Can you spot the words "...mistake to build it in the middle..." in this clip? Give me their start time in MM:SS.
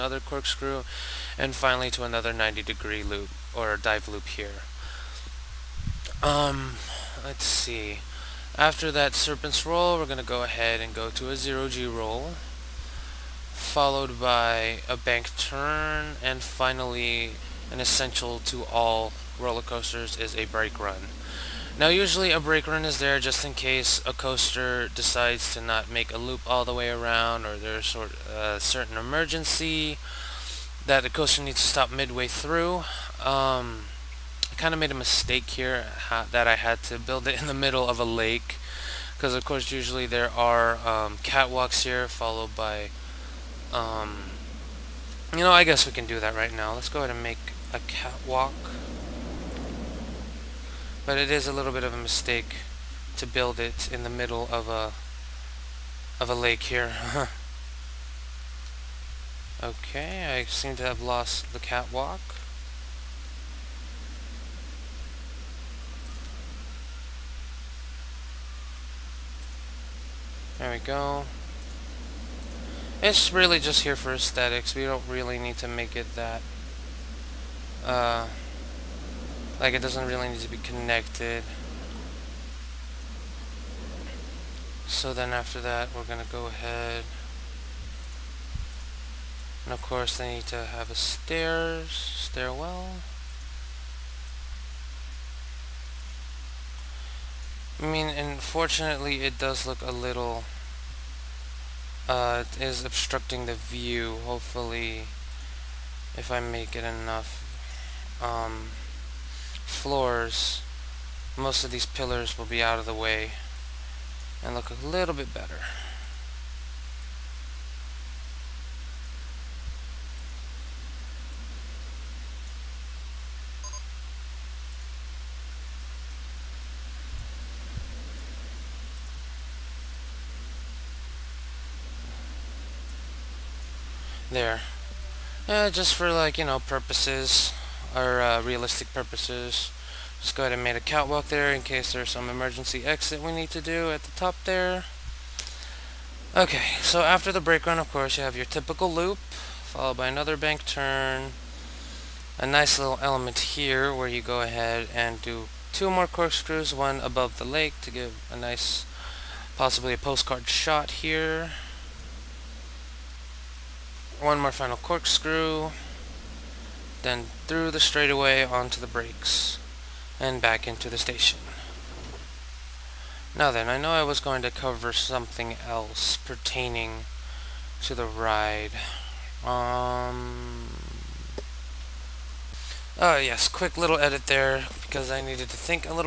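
00:51.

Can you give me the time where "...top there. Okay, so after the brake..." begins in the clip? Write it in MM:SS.
02:24.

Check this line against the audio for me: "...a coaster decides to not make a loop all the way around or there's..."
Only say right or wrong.
right.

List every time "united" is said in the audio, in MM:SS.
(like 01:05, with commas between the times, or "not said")
not said.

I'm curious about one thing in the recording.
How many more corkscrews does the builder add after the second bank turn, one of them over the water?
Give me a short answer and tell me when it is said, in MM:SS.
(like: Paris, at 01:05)
2, at 02:35.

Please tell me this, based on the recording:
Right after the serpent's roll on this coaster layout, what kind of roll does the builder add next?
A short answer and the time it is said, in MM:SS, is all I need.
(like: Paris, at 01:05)
0G roll, at 00:11.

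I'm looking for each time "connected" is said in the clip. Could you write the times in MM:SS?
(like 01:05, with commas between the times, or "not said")
01:20.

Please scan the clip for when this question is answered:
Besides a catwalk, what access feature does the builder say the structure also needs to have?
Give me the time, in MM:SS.
01:31.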